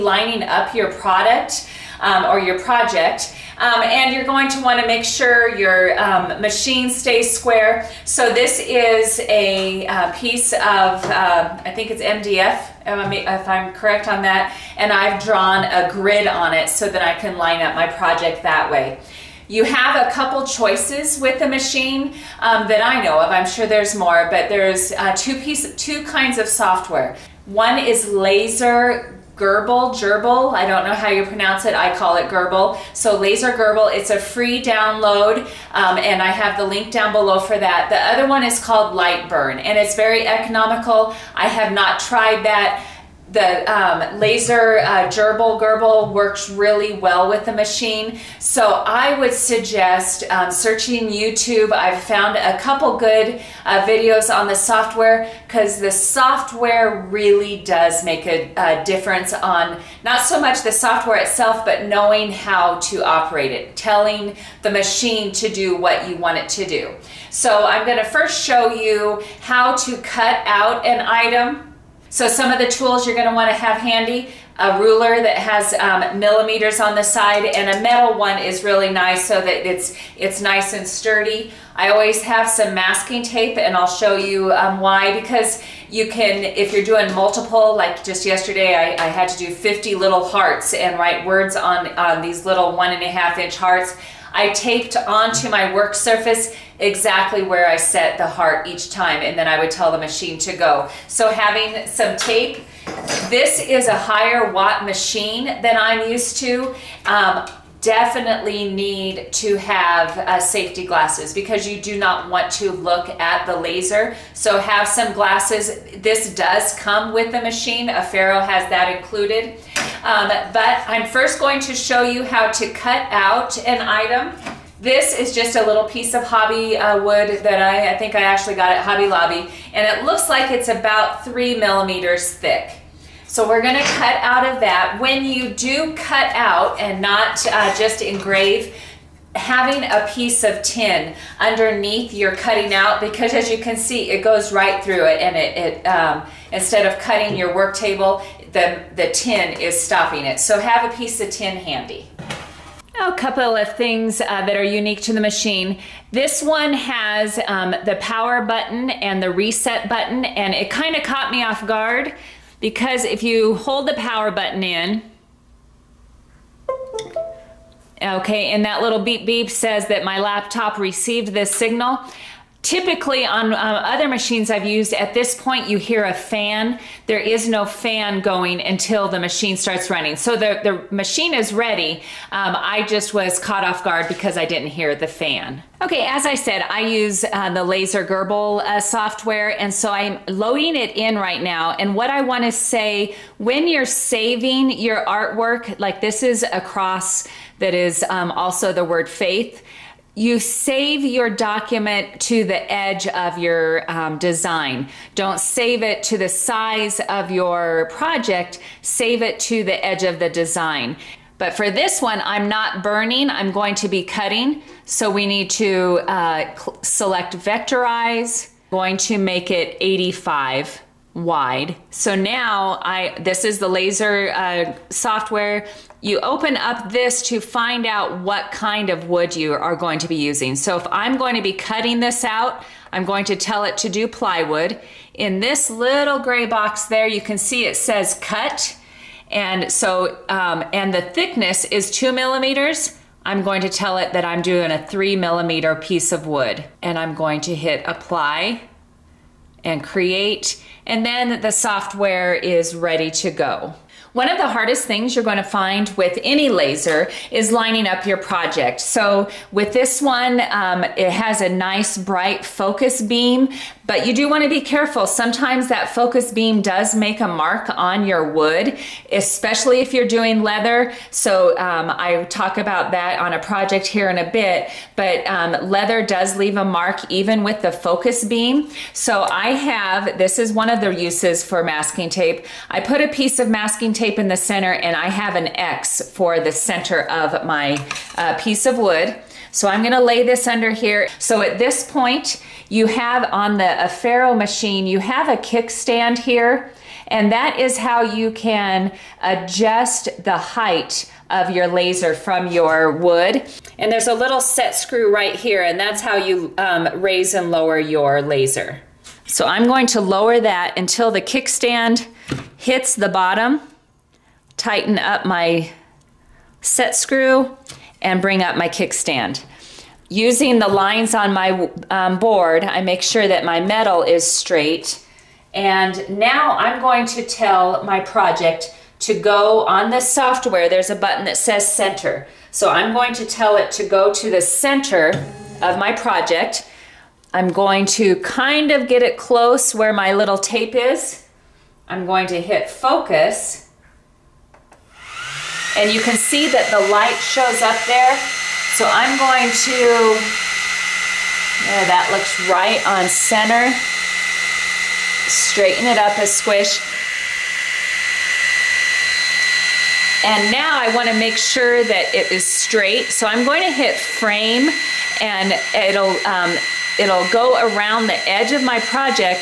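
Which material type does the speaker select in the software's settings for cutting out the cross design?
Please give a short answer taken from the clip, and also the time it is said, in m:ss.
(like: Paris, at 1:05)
Plywood, at 3:54.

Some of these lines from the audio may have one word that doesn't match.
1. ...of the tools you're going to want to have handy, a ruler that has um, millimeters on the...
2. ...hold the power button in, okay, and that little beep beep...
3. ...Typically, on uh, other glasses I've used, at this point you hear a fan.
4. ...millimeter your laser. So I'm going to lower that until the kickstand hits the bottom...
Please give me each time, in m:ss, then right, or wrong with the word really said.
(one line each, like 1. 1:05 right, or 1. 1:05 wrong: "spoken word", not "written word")
1. 1:12 right
2. 2:43 right
3. 2:52 wrong: "machines", not "glasses"
4. 5:07 wrong: "lower", not "millimeter".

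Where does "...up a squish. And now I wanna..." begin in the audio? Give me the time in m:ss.
5:55.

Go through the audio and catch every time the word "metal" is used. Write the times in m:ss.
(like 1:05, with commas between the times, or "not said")
1:17, 5:23.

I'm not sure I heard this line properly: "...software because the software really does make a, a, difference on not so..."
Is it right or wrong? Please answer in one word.
right.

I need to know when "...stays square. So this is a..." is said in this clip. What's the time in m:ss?
0:06.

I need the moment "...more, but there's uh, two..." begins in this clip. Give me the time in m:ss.
0:23.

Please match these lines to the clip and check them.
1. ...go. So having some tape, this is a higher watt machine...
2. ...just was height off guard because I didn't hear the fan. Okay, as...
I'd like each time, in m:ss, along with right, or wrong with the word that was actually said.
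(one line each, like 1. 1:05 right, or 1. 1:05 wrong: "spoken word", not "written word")
1. 1:40 right
2. 3:02 wrong: "caught", not "height".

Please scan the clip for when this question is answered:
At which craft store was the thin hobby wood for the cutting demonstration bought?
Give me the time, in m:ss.
2:08.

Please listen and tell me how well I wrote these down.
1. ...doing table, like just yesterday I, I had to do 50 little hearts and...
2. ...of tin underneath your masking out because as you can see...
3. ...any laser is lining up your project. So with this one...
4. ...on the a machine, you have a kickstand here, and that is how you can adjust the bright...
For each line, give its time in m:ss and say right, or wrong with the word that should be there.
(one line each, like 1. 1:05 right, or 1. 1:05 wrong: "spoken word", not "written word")
1. 1:26 wrong: "multiple", not "table"
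2. 2:20 wrong: "cutting", not "masking"
3. 4:16 right
4. 4:53 wrong: "height", not "bright".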